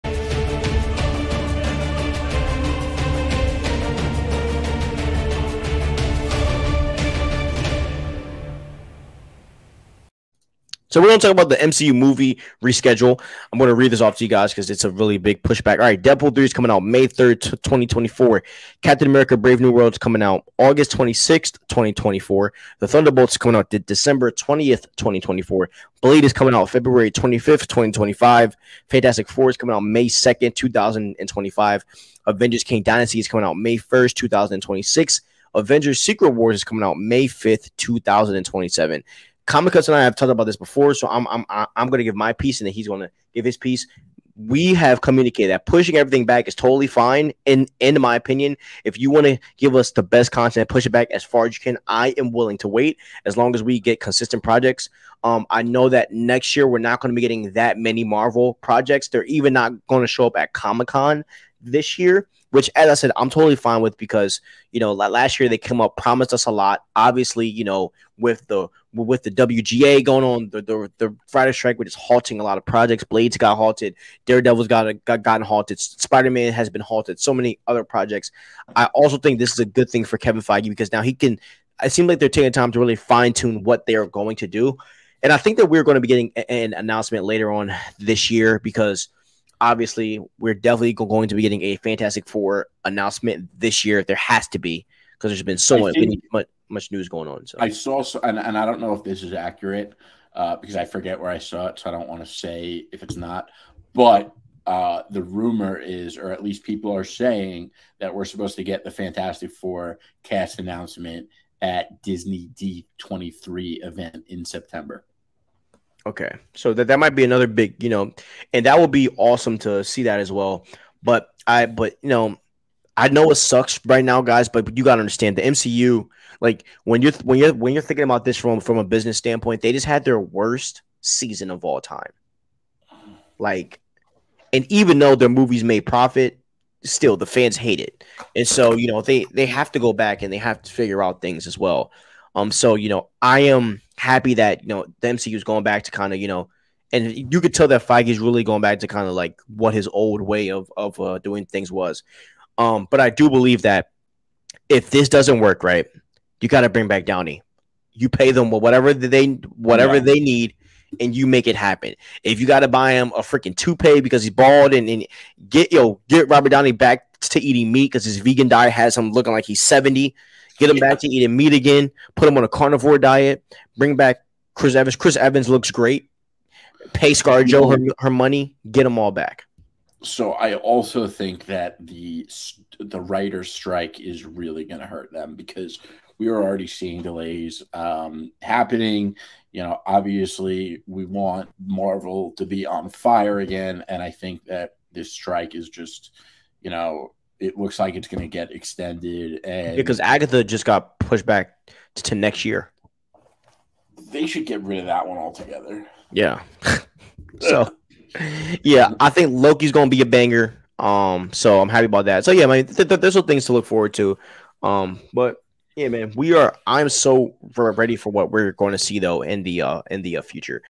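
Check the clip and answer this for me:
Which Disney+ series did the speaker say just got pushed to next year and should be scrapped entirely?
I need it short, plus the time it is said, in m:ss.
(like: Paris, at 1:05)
Agatha, at 3:19.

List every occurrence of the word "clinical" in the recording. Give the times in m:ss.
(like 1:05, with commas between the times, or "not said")
not said.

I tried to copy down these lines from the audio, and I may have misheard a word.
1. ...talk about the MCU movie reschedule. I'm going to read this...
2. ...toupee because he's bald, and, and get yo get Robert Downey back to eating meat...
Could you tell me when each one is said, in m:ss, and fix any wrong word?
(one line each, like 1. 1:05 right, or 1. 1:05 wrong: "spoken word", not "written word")
1. 0:11 right
2. 2:43 right.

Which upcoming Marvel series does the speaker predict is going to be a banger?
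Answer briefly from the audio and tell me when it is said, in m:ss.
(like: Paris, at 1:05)
Loki, at 3:29.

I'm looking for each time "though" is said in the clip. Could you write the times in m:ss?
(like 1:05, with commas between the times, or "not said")
2:14, 3:38.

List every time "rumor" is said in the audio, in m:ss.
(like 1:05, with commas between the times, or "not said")
1:45.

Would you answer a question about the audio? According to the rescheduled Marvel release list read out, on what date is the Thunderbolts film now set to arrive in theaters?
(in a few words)
December 20, 2024.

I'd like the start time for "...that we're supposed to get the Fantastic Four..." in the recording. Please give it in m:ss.
1:47.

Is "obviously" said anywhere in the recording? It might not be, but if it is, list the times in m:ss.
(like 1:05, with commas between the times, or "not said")
1:06, 1:29, 3:09.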